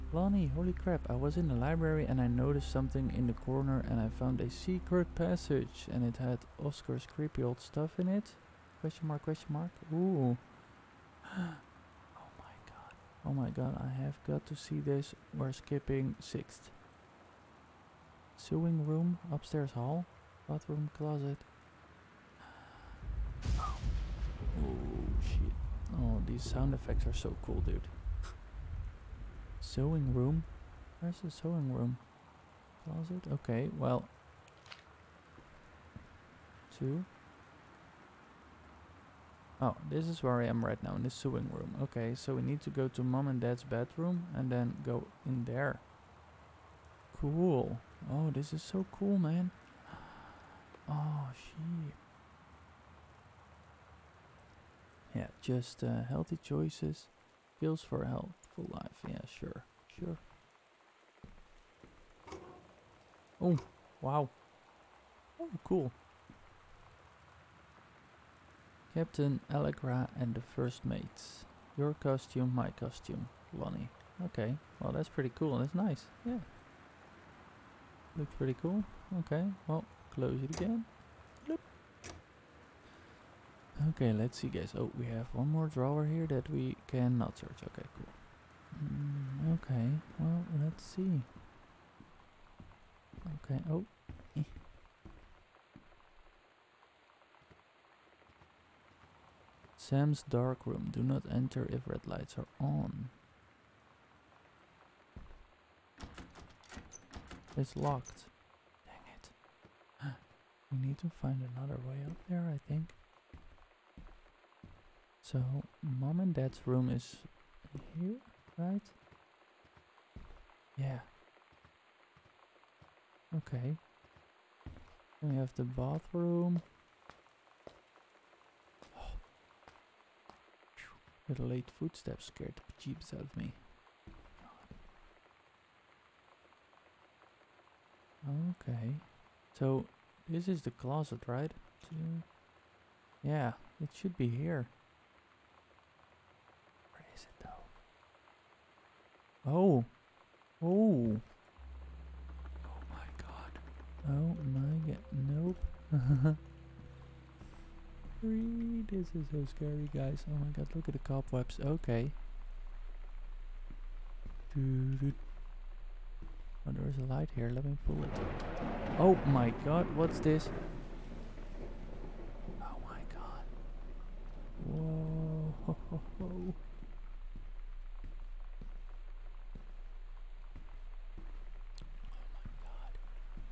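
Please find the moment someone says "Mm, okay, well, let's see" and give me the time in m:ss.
1:28.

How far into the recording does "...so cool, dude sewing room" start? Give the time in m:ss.
0:27.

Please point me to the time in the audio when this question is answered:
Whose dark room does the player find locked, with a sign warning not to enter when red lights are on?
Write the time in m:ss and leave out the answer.
1:39.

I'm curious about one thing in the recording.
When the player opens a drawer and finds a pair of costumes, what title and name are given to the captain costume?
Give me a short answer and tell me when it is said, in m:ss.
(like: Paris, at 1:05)
Captain Allegra, at 1:08.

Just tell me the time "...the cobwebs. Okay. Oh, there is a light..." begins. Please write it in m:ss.
2:40.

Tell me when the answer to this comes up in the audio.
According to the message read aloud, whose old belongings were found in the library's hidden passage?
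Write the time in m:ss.
0:06.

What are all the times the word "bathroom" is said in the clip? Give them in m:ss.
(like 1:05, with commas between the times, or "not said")
0:20, 2:05.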